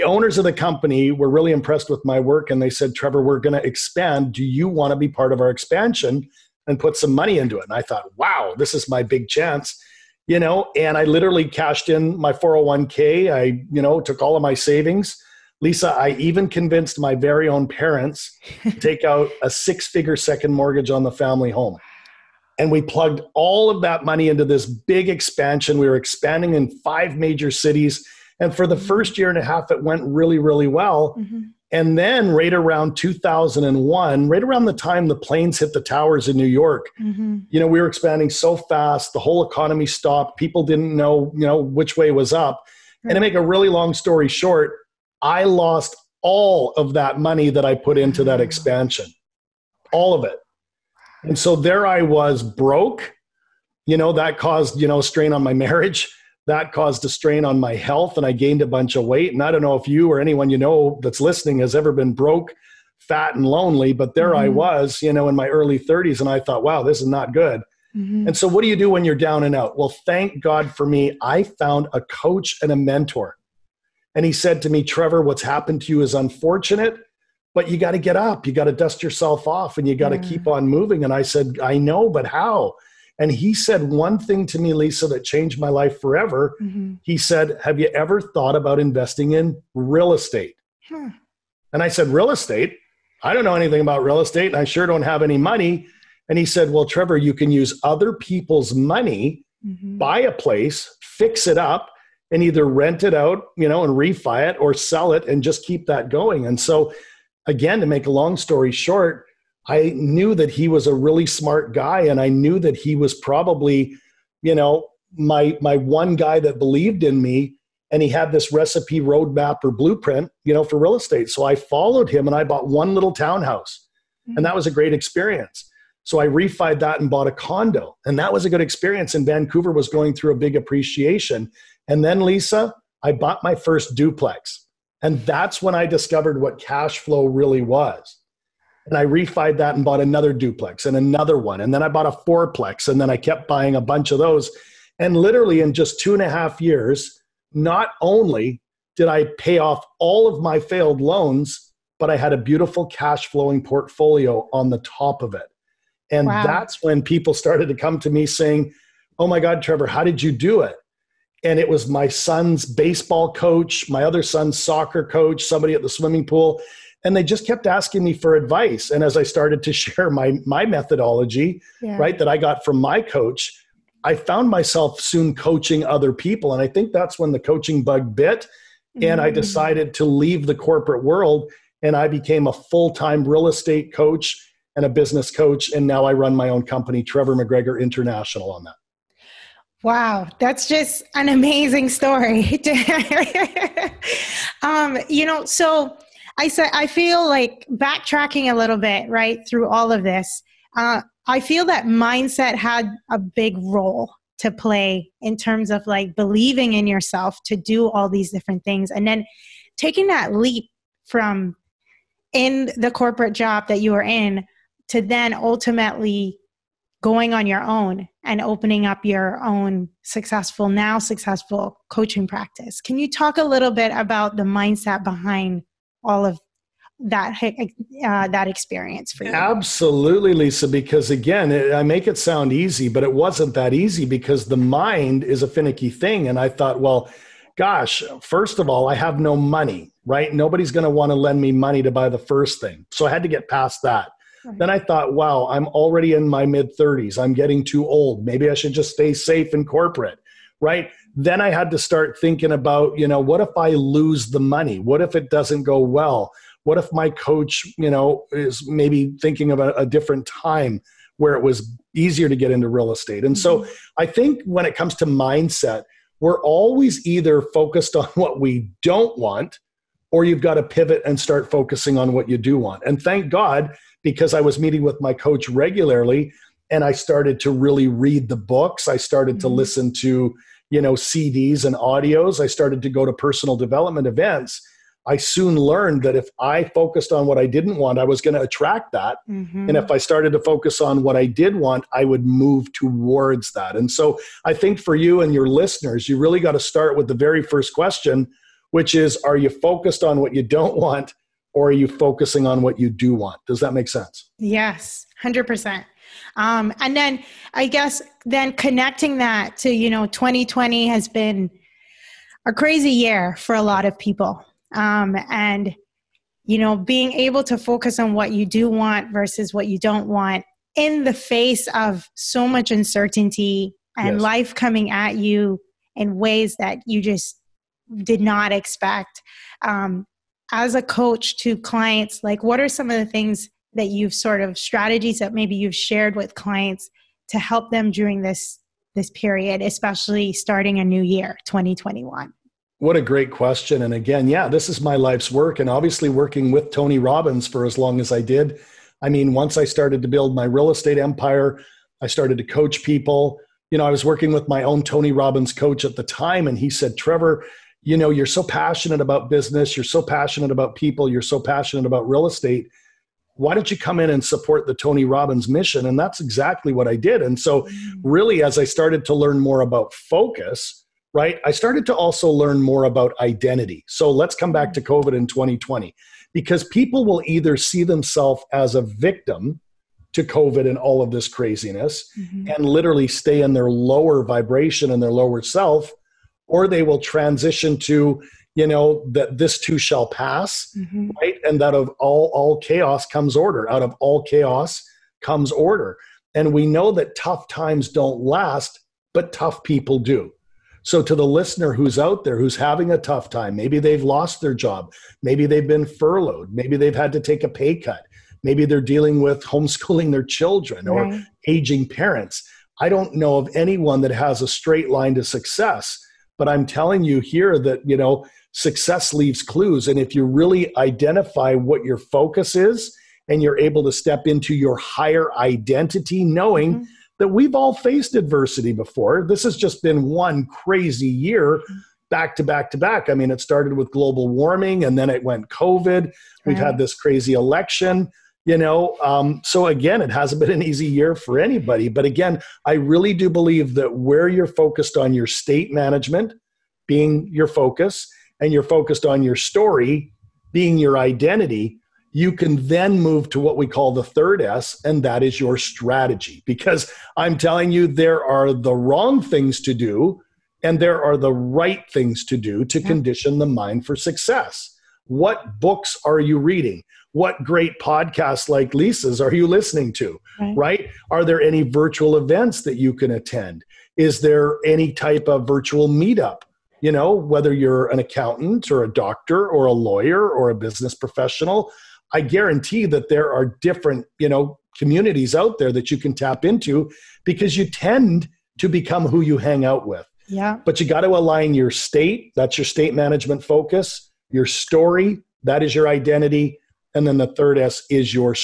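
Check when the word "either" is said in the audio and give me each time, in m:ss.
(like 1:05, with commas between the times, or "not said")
1:42, 4:27, 6:17.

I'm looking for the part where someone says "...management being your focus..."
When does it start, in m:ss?
7:25.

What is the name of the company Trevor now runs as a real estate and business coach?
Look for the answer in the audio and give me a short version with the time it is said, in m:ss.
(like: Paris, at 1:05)
Trevor McGregor International, at 3:07.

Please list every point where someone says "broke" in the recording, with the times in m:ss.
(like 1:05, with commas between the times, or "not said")
0:52, 1:02.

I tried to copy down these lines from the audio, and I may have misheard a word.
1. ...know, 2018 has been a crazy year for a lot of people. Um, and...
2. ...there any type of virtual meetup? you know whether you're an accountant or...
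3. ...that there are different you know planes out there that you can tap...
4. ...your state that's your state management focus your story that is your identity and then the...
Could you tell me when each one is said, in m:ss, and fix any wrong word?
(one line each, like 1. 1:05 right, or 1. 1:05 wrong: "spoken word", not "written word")
1. 5:09 wrong: "2020", not "2018"
2. 7:54 right
3. 8:02 wrong: "communities", not "planes"
4. 8:11 right.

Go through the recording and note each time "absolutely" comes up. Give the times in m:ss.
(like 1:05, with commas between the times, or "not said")
3:49.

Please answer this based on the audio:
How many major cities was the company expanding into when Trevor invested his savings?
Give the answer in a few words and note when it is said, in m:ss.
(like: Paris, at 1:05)
5, at 0:26.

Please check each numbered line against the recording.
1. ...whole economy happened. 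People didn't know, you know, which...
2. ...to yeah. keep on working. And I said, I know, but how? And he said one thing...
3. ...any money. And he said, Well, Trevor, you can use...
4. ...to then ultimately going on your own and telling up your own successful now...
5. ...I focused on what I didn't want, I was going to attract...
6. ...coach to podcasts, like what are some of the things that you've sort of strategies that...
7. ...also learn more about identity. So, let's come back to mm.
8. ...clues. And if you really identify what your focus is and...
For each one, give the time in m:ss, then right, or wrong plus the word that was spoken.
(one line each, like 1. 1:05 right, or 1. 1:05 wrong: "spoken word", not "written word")
1. 0:39 wrong: "stopped", not "happened"
2. 1:20 wrong: "moving", not "working"
3. 1:35 right
4. 3:34 wrong: "opening", not "telling"
5. 4:46 right
6. 5:30 wrong: "clients", not "podcasts"
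7. 6:11 right
8. 6:59 right.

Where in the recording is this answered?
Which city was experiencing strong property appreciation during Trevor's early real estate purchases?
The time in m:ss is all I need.
2:09.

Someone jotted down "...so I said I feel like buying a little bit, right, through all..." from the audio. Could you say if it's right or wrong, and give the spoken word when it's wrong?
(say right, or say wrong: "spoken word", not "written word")
wrong: "backtracking", not "buying".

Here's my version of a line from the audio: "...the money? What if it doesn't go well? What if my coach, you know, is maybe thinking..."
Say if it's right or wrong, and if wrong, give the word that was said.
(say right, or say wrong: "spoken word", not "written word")
right.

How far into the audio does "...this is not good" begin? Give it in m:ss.
1:06.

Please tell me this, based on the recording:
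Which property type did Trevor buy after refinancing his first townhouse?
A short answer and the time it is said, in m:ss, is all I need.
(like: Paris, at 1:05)
condo, at 2:07.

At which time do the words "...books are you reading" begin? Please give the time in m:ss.
7:45.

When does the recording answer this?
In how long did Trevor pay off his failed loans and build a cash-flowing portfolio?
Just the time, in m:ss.
2:25.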